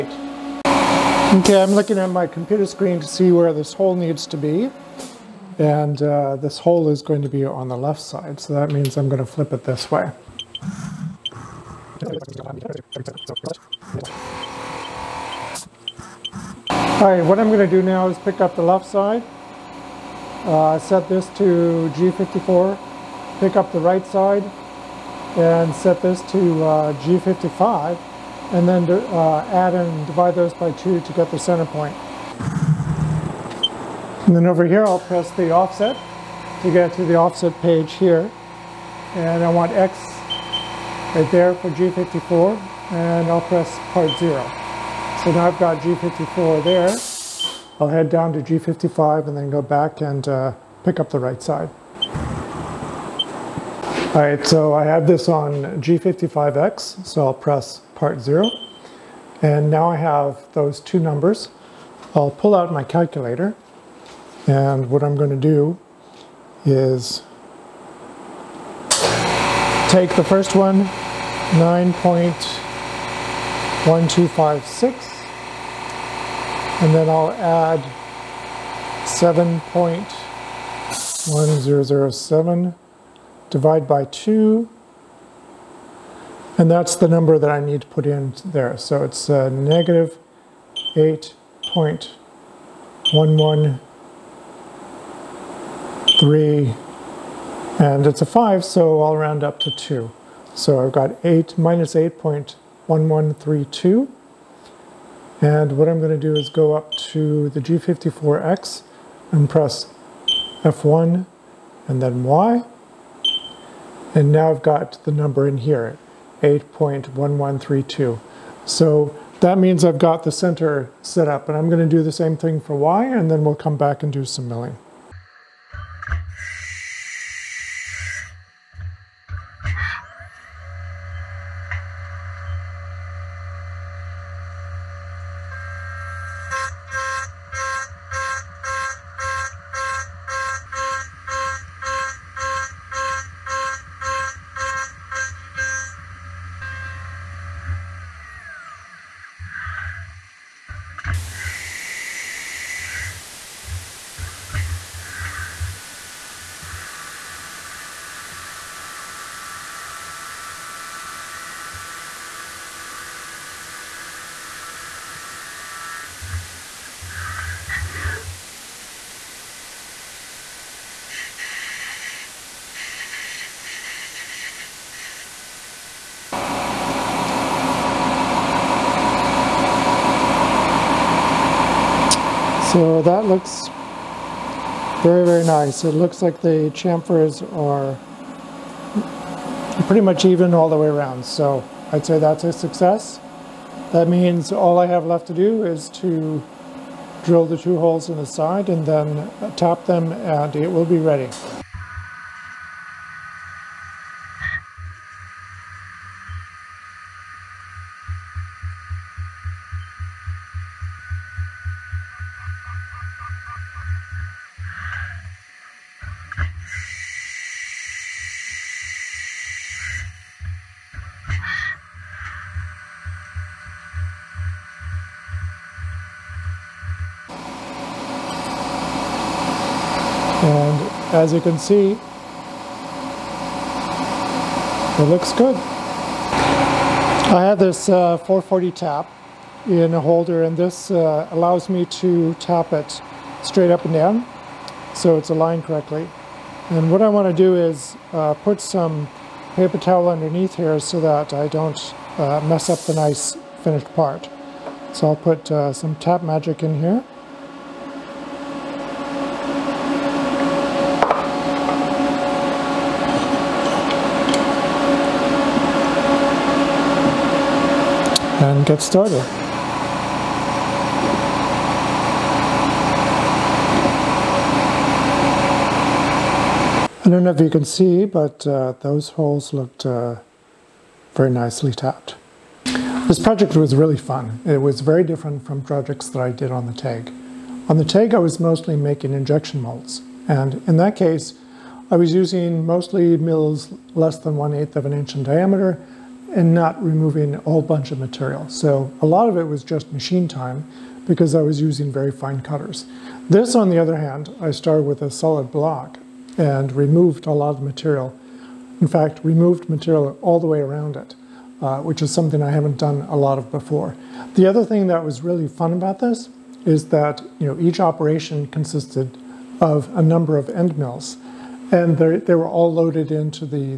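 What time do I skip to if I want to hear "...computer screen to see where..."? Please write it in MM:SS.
00:02.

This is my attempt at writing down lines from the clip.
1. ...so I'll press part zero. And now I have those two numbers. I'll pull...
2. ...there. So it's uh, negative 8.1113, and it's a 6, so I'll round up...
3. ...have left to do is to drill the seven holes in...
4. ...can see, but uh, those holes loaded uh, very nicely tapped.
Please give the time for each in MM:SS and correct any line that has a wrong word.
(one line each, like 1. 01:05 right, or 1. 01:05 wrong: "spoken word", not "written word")
1. 00:57 right
2. 01:28 wrong: "5", not "6"
3. 03:14 wrong: "two", not "seven"
4. 04:37 wrong: "looked", not "loaded".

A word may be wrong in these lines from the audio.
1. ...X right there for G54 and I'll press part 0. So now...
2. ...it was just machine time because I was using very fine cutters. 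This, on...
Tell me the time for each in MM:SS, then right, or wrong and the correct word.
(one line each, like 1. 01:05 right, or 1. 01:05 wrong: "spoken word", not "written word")
1. 00:39 right
2. 04:59 right.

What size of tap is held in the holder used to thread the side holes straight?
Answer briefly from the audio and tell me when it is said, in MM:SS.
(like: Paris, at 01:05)
440, at 03:58.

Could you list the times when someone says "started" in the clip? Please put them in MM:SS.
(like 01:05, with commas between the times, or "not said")
04:28, 05:04.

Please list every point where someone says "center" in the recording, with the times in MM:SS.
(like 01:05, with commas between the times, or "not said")
00:31, 02:00.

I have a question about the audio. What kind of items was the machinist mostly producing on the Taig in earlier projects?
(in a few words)
injection molds.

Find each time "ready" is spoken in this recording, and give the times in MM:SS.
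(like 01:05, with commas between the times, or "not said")
03:20.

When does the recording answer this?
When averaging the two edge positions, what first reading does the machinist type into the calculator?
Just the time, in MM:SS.
01:10.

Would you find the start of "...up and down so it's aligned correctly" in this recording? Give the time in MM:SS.
04:03.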